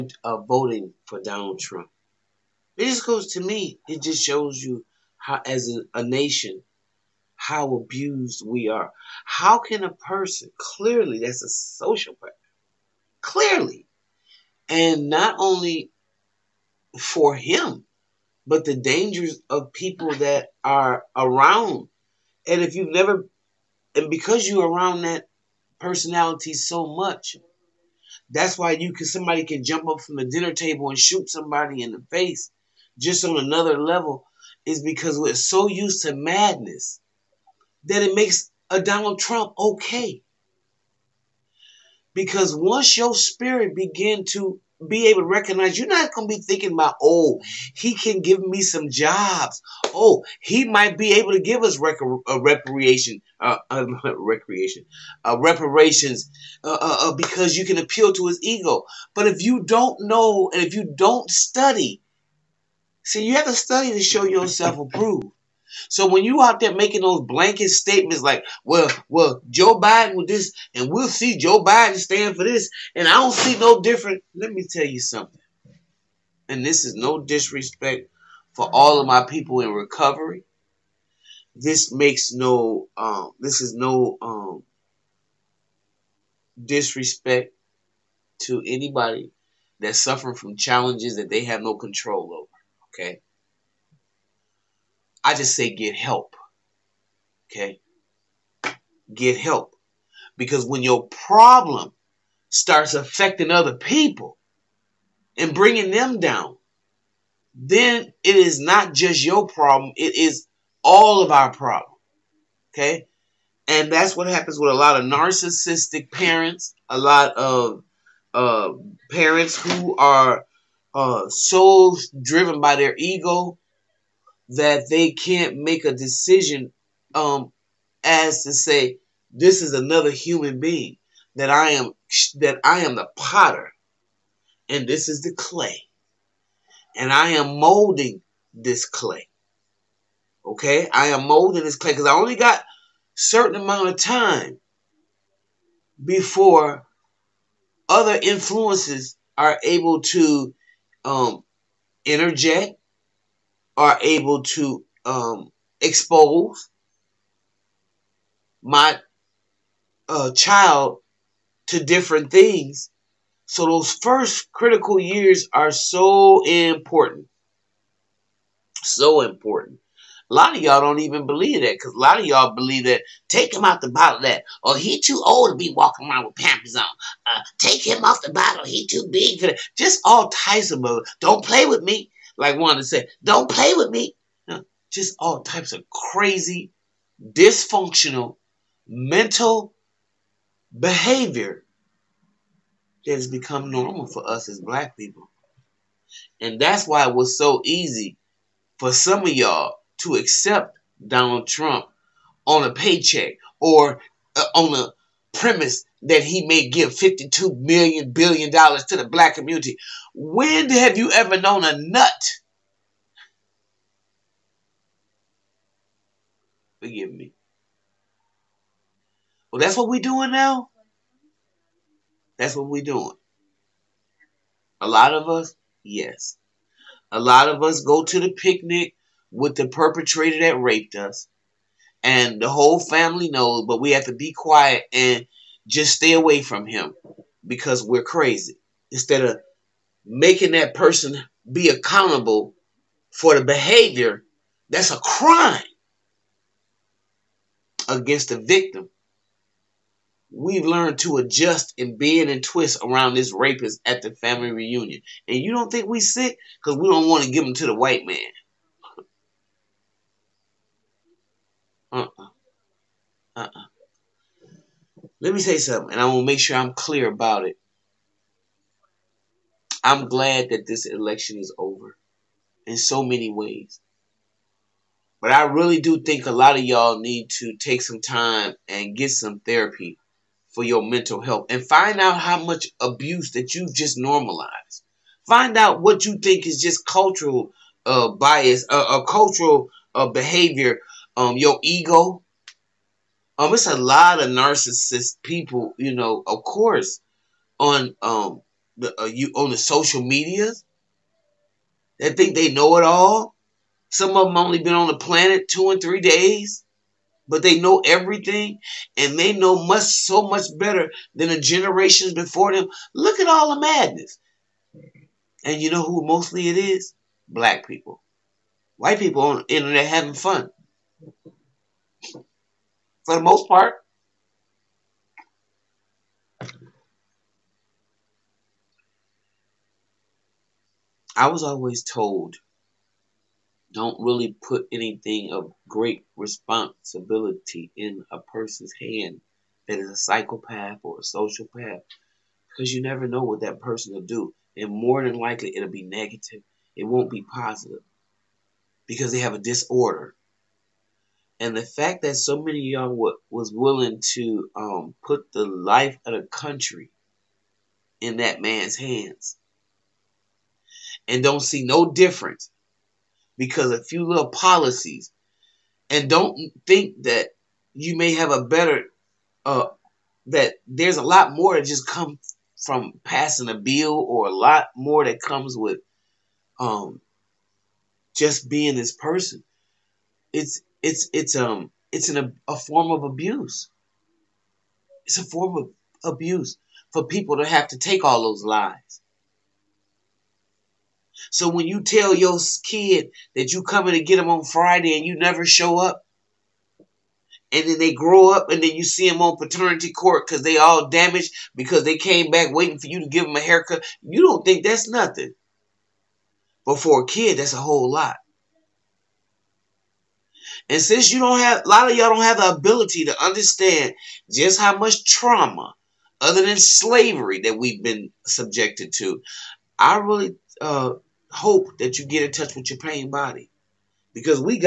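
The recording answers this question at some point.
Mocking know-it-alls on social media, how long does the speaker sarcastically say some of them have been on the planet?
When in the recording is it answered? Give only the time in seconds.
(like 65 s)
305 s.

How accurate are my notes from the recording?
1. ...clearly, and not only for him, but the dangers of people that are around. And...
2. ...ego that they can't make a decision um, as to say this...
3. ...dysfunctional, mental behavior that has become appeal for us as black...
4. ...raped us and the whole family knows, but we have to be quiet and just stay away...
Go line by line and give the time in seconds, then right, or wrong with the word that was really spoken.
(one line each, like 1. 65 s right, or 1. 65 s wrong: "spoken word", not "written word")
1. 13 s right
2. 122 s right
3. 187 s wrong: "normal", not "appeal"
4. 230 s right.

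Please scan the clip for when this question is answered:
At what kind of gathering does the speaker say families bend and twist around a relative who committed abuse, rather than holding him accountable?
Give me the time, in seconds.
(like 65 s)
254 s.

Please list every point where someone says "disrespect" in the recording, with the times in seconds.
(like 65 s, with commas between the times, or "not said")
77 s, 86 s.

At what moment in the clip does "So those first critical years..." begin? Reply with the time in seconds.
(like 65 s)
163 s.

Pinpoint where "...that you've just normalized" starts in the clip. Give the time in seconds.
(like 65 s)
283 s.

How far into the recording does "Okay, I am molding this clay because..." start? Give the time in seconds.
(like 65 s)
140 s.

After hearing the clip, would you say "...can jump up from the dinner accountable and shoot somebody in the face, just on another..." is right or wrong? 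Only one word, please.
wrong.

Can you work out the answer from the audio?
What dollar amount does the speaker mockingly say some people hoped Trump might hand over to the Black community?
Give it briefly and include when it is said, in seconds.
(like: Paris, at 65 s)
52 million billion dollars, at 206 s.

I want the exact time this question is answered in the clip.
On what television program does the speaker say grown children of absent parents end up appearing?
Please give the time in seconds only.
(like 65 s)
399 s.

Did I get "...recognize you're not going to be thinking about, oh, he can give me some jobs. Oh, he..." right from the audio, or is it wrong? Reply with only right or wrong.
right.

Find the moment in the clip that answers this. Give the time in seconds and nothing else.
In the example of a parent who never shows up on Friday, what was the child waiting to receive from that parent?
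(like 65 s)
403 s.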